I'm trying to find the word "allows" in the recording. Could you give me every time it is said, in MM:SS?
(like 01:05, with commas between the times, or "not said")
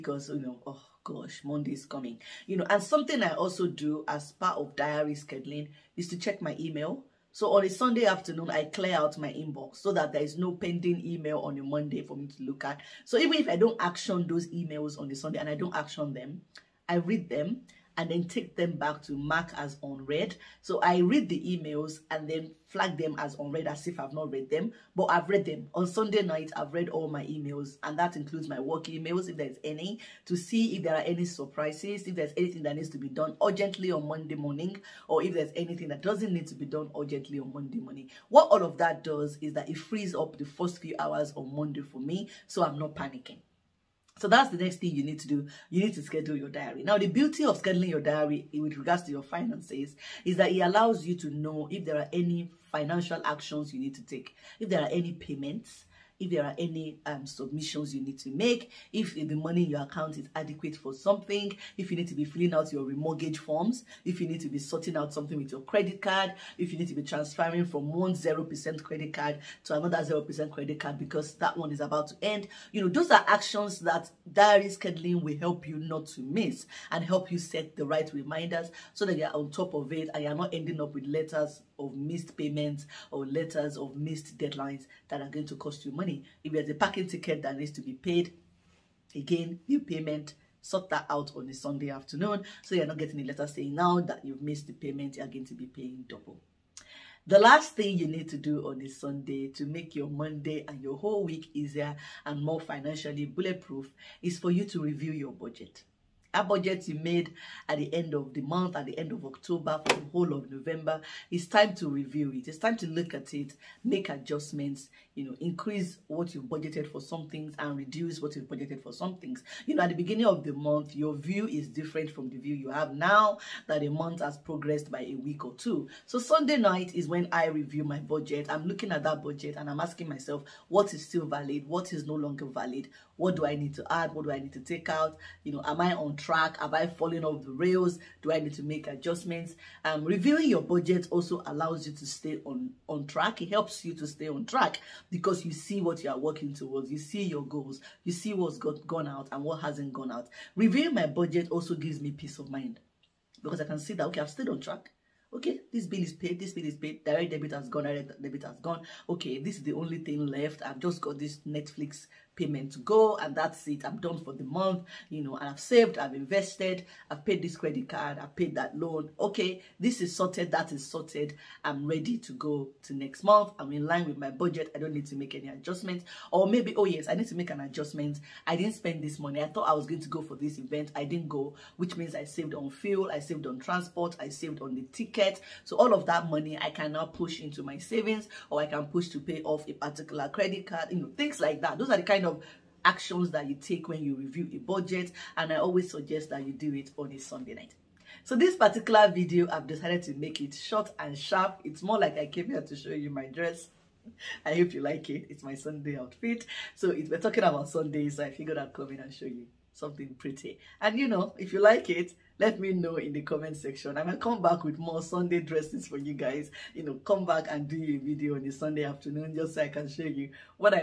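00:50, 02:21.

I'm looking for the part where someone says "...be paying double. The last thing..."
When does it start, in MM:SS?
01:35.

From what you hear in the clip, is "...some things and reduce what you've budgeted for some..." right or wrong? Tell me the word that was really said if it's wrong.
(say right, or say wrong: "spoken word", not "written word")
right.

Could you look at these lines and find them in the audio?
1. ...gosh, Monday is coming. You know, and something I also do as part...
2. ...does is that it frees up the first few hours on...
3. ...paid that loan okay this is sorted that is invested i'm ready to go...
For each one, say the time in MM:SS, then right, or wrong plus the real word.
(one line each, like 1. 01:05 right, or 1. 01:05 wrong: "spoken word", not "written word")
1. 00:01 right
2. 00:39 right
3. 02:48 wrong: "sorted", not "invested".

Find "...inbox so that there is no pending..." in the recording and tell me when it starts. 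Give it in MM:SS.
00:09.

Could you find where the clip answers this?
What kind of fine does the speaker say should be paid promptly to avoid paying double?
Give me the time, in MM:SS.
01:26.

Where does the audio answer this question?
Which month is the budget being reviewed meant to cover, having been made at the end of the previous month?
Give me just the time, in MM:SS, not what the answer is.
01:50.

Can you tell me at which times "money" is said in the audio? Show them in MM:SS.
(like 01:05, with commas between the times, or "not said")
00:59, 01:25, 02:59, 03:06.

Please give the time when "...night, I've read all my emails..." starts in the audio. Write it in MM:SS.
00:26.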